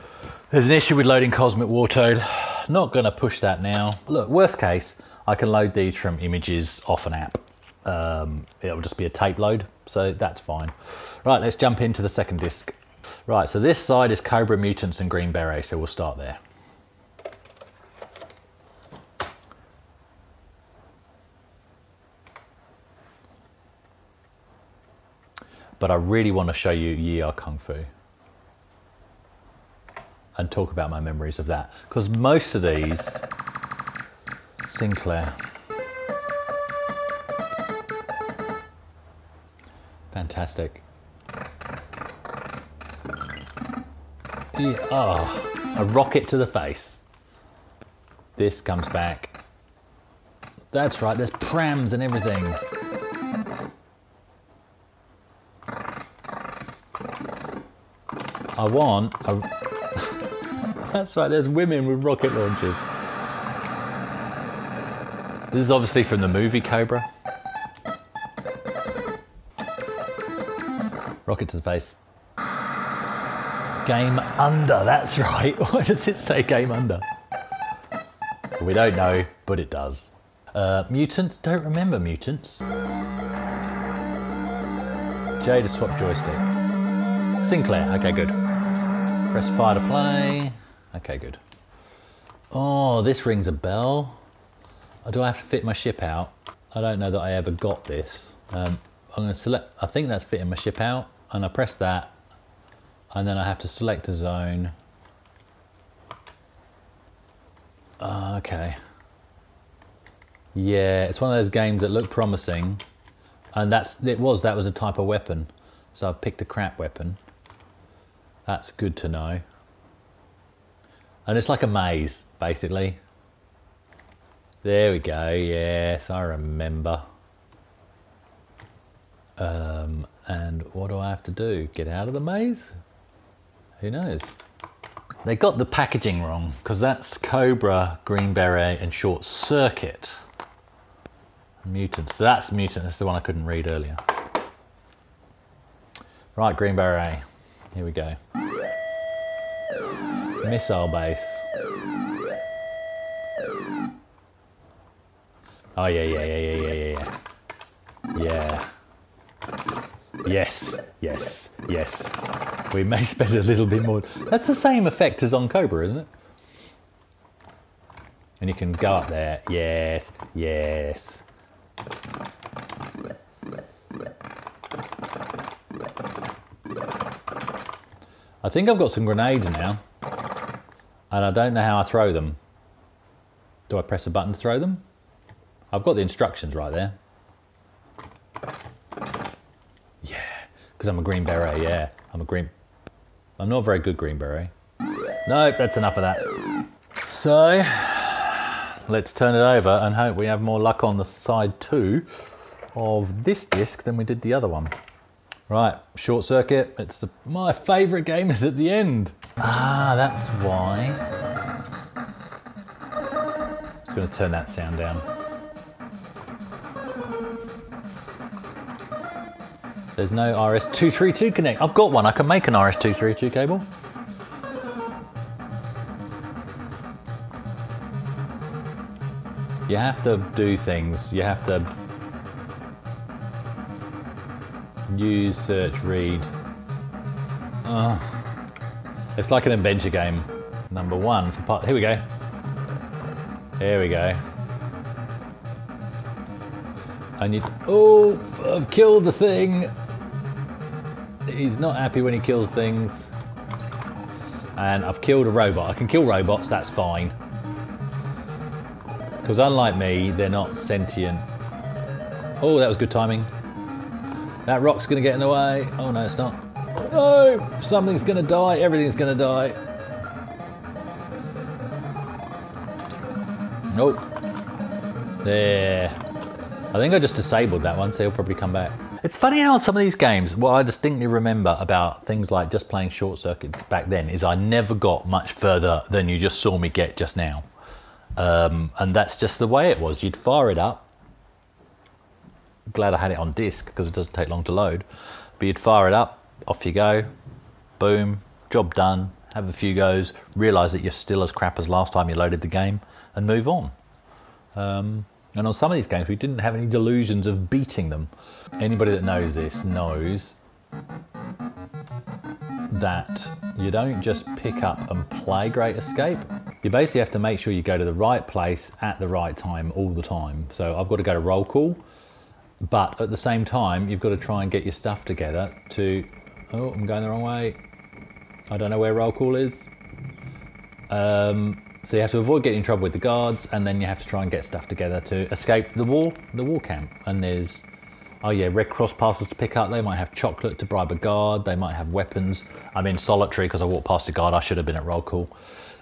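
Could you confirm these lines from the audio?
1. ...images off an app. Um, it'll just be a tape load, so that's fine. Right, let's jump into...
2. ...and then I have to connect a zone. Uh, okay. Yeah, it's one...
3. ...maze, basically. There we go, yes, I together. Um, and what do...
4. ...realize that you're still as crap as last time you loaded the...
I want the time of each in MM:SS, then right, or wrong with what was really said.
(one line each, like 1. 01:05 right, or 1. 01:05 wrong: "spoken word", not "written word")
1. 00:06 right
2. 01:43 wrong: "select", not "connect"
3. 02:01 wrong: "remember", not "together"
4. 05:00 right.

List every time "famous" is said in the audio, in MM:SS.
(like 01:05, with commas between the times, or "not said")
not said.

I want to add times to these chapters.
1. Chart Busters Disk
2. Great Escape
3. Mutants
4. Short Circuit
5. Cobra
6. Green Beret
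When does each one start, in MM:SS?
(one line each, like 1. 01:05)
1. 00:10
2. 05:06
3. 01:19
4. 03:17
5. 00:21
6. 02:14.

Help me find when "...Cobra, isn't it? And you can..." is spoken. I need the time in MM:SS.
02:45.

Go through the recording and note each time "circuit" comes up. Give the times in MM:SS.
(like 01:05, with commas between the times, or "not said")
02:19, 03:26, 04:43.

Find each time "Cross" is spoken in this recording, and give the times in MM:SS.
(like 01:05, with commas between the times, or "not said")
05:38.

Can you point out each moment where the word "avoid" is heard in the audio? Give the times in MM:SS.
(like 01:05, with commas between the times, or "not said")
05:32.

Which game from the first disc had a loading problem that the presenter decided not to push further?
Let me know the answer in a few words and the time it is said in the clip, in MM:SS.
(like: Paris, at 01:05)
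Cosmic Wartoad, at 00:01.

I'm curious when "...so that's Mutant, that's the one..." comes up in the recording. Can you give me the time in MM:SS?
02:22.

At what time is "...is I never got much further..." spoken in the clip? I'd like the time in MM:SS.
04:44.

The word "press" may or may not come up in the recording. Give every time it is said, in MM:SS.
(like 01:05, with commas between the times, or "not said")
01:29, 01:41, 03:03.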